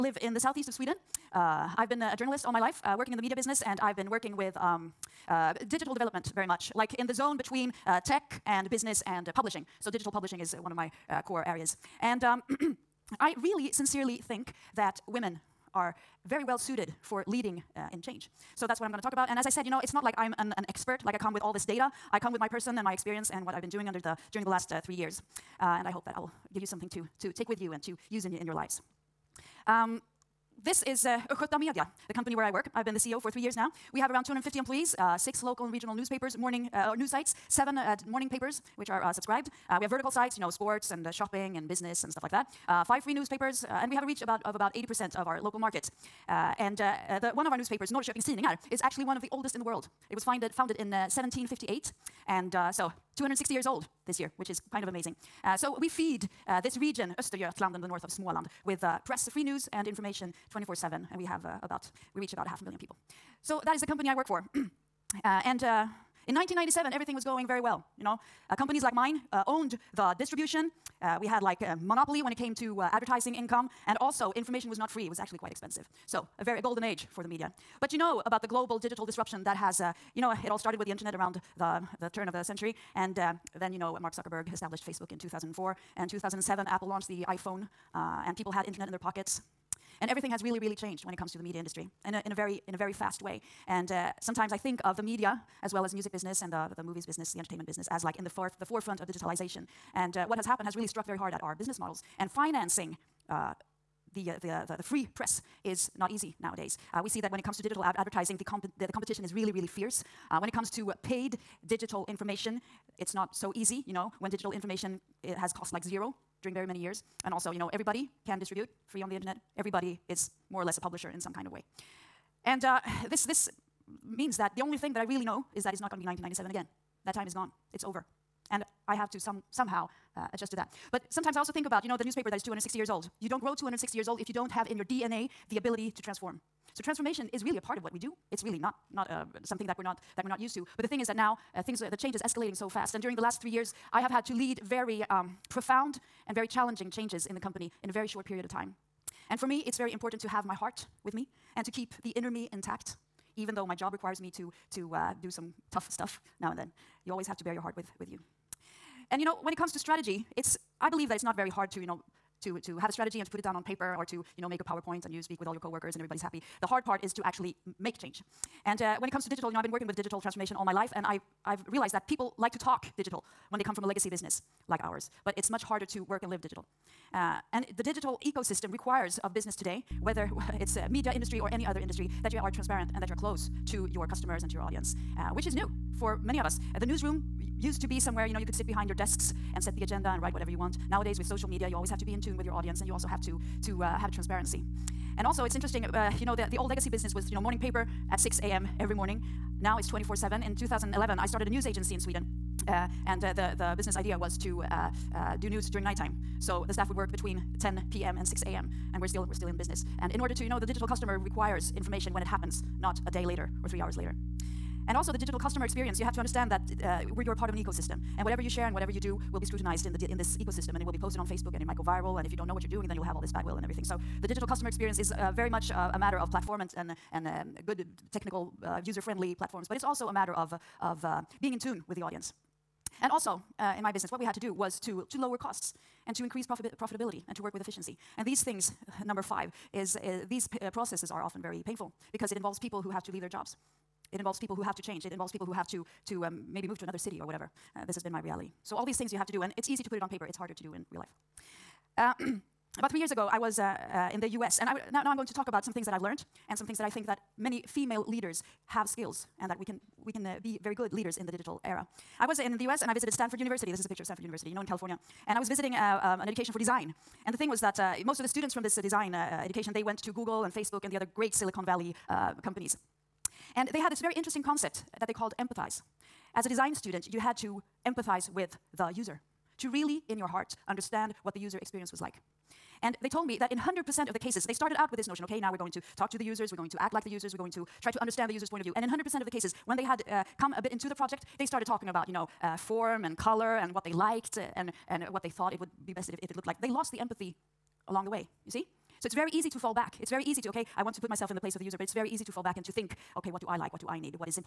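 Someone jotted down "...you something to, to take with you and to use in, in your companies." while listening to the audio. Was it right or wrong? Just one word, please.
wrong.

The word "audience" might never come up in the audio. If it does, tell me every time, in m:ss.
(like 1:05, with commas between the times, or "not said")
3:04, 3:12, 3:52.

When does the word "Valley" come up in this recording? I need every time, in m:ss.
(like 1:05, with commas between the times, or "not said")
4:31.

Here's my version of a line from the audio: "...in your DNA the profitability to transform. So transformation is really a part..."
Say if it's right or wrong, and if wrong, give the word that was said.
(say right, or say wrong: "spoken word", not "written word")
wrong: "ability", not "profitability".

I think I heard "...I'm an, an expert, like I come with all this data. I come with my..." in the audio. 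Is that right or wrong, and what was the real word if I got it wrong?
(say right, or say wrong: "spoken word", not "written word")
right.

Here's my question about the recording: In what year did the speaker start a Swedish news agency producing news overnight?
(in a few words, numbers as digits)
2011.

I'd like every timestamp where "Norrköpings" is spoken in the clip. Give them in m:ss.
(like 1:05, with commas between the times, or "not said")
0:47.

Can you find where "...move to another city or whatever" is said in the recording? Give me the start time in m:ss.
4:06.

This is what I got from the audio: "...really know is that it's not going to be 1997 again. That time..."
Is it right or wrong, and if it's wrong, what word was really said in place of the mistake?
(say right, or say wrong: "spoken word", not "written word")
right.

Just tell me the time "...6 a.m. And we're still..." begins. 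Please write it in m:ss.
3:28.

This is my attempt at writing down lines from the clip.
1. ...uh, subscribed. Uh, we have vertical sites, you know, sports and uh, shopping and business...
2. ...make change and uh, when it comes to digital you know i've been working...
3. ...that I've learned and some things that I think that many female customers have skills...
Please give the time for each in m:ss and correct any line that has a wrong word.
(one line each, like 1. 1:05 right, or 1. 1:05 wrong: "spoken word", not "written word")
1. 0:39 right
2. 2:47 right
3. 4:15 wrong: "leaders", not "customers".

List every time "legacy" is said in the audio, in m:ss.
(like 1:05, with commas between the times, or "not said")
2:53, 3:16.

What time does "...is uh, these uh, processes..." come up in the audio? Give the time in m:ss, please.
3:59.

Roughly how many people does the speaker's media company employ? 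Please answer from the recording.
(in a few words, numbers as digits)
250.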